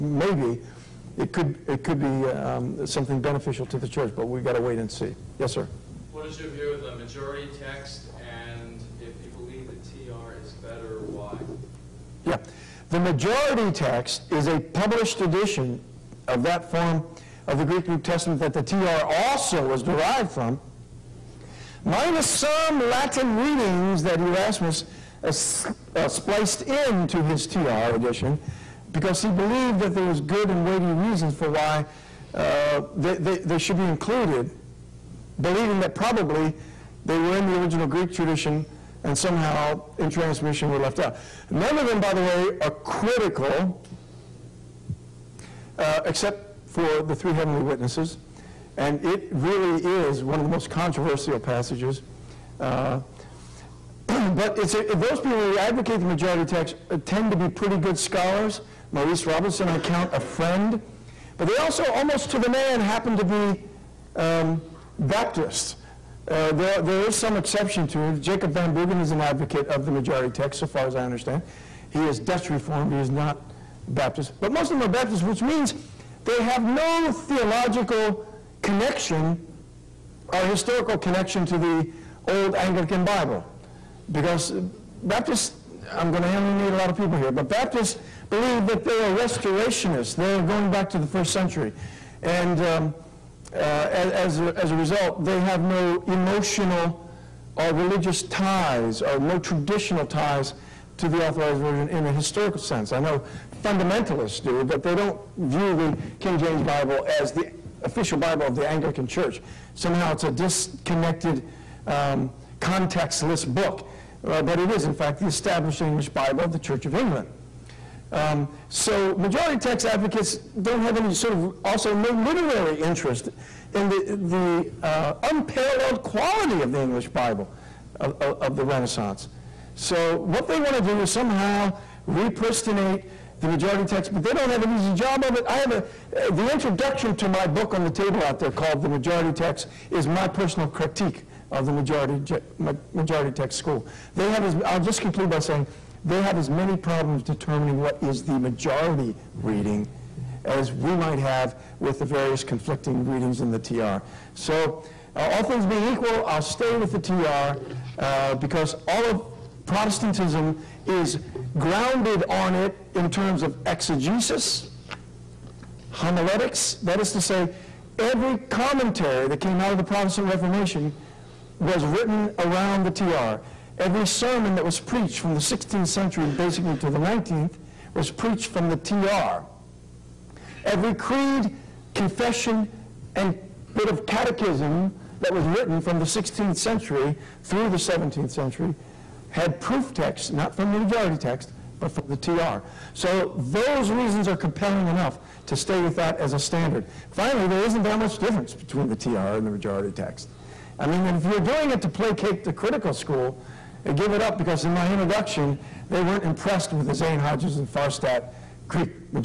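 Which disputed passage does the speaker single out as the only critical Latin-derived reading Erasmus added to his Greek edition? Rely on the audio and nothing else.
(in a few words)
The three heavenly witnesses.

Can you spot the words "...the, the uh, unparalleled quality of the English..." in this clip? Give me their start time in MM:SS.
02:03.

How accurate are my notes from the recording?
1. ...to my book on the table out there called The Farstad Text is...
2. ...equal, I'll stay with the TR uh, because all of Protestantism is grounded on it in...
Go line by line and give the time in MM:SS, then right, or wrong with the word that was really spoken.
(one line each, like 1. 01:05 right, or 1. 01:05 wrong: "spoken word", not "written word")
1. 02:17 wrong: "Majority", not "Farstad"
2. 02:35 right.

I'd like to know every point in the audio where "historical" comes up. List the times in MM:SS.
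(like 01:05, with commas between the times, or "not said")
01:20, 01:42.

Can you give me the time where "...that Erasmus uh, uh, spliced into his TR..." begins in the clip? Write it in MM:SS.
00:24.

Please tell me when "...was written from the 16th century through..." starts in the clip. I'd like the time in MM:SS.
03:05.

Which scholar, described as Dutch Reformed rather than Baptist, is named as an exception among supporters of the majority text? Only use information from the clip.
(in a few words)
Jacob Van Bruggen.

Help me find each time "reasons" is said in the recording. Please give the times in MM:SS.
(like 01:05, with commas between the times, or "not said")
00:30, 03:13.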